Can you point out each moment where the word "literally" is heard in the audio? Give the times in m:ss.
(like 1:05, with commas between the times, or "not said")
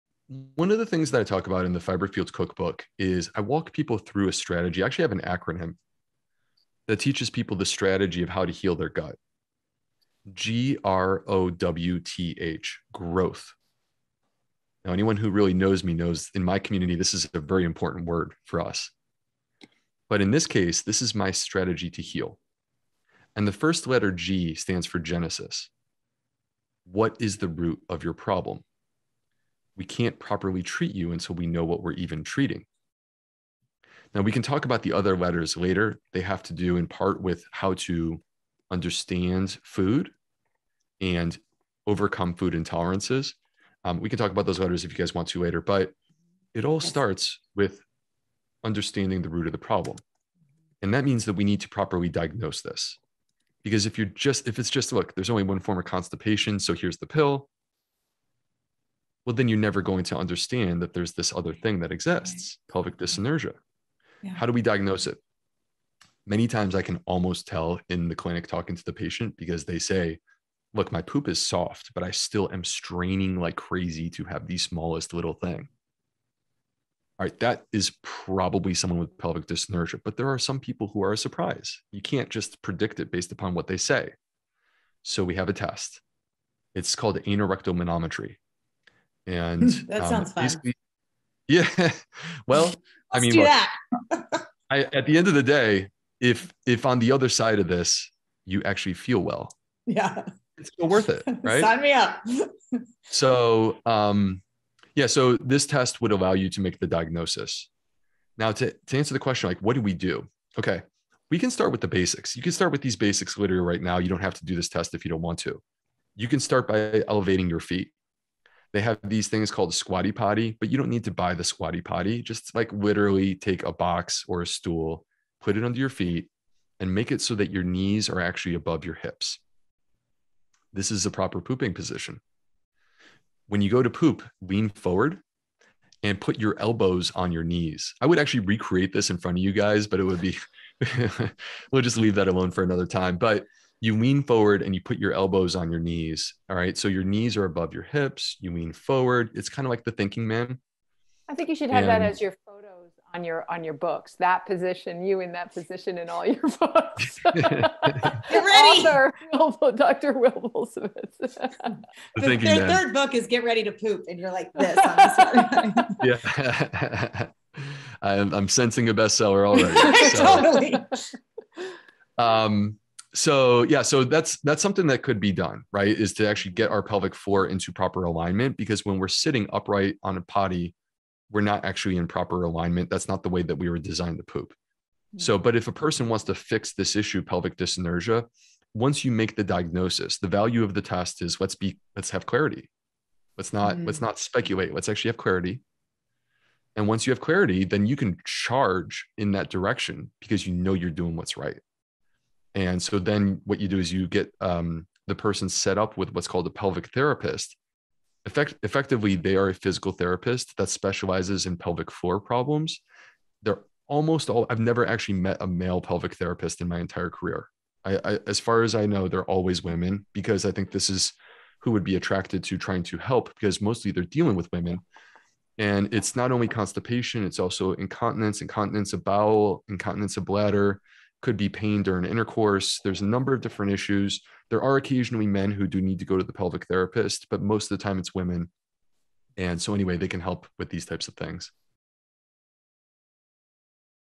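1:53, 2:02.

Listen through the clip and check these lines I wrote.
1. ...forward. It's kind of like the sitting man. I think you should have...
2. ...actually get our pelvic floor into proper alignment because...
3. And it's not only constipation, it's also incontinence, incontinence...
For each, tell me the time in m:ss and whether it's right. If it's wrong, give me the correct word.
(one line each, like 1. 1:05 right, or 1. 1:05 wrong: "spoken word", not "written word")
1. 2:28 wrong: "thinking", not "sitting"
2. 2:56 right
3. 3:45 right.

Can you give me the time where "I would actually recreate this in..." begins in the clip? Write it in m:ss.
2:17.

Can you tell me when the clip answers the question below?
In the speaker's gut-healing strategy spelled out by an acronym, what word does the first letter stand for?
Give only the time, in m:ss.
0:24.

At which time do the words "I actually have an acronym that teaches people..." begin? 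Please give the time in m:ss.
0:04.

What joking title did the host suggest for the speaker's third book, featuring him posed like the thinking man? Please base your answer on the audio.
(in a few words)
Get Ready to Poop.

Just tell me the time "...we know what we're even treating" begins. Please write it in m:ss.
0:31.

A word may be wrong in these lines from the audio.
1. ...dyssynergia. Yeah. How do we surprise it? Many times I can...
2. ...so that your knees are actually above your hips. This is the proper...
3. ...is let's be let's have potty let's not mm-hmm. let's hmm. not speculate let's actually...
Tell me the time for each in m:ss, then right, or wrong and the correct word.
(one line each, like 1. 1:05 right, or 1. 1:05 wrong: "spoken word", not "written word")
1. 1:02 wrong: "diagnose", not "surprise"
2. 2:07 right
3. 3:11 wrong: "clarity", not "potty".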